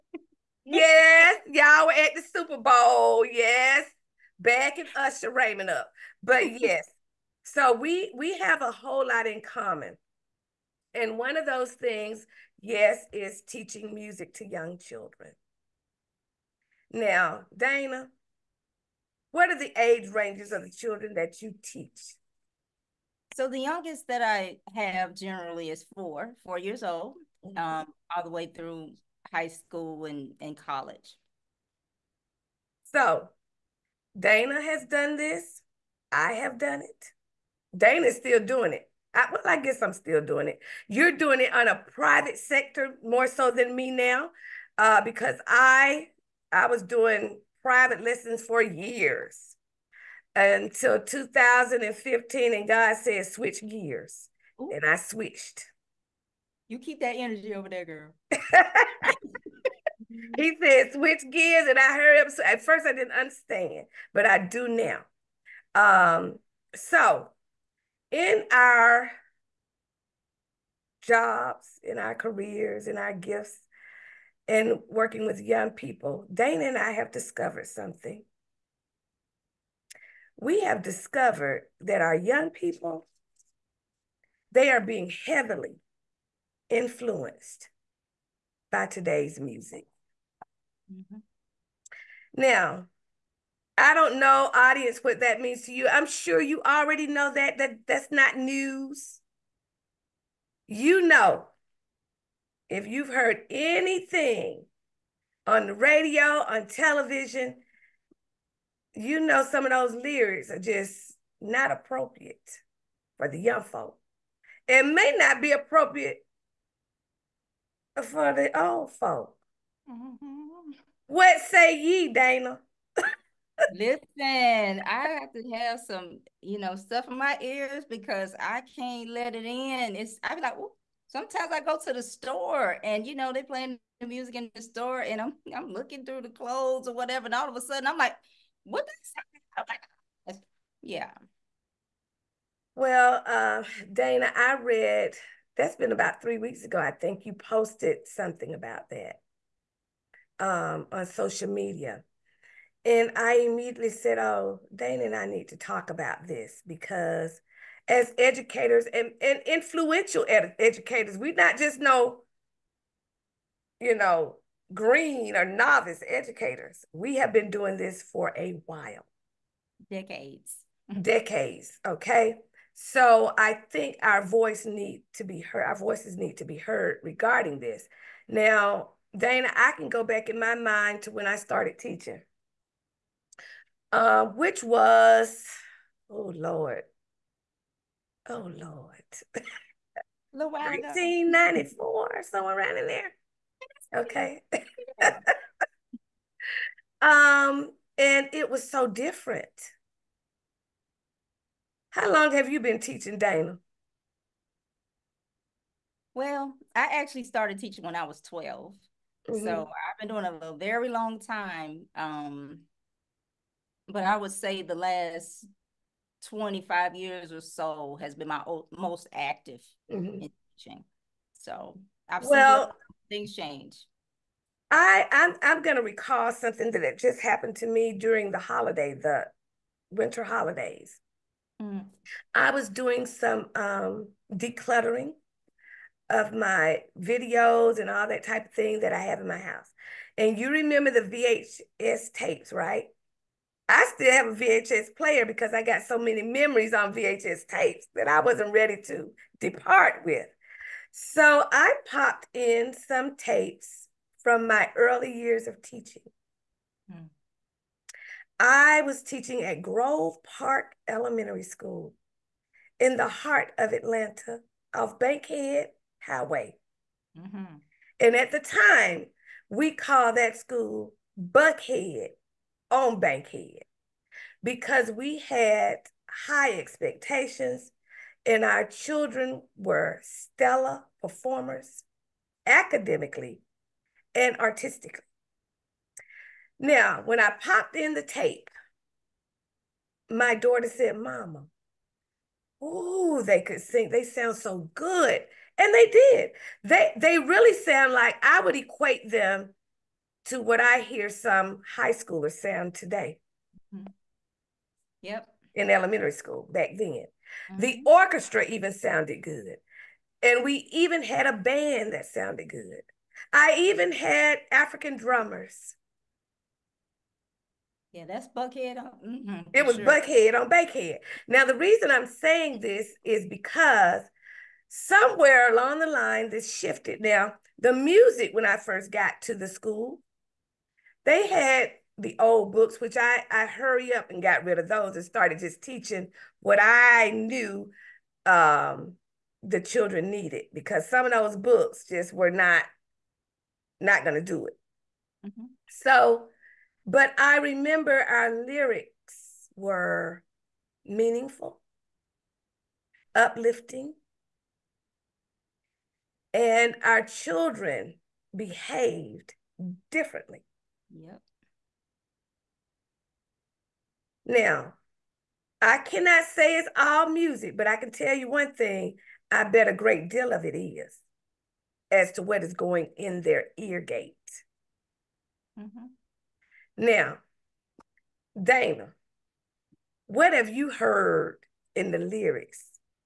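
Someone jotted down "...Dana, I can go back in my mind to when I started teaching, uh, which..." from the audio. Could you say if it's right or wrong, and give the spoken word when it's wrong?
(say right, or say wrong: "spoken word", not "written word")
right.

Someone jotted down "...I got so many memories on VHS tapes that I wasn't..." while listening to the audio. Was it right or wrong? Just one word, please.
right.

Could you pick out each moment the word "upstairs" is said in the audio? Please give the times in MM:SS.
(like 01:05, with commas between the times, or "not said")
not said.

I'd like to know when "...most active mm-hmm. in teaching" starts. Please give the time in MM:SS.
03:38.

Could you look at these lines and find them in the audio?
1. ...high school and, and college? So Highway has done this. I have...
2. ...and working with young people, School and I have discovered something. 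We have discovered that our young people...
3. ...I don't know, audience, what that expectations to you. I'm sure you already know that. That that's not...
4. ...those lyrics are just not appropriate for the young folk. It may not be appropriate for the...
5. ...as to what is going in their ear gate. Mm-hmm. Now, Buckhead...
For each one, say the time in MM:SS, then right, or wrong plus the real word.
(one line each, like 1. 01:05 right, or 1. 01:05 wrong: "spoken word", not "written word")
1. 00:29 wrong: "Dana", not "Highway"
2. 01:14 wrong: "Dana", not "School"
3. 01:33 wrong: "means", not "expectations"
4. 01:49 right
5. 06:11 wrong: "Dana", not "Buckhead".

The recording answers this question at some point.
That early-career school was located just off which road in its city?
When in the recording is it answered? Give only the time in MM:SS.
04:24.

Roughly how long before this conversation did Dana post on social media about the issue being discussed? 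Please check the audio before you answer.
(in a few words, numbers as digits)
about 3 weeks ago.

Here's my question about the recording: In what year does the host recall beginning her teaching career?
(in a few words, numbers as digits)
1994.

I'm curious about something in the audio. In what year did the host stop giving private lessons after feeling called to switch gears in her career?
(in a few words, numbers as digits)
2015.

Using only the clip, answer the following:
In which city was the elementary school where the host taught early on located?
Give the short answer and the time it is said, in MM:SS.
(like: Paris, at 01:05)
Atlanta, at 04:23.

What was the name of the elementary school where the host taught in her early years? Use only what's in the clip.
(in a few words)
Grove Park Elementary School.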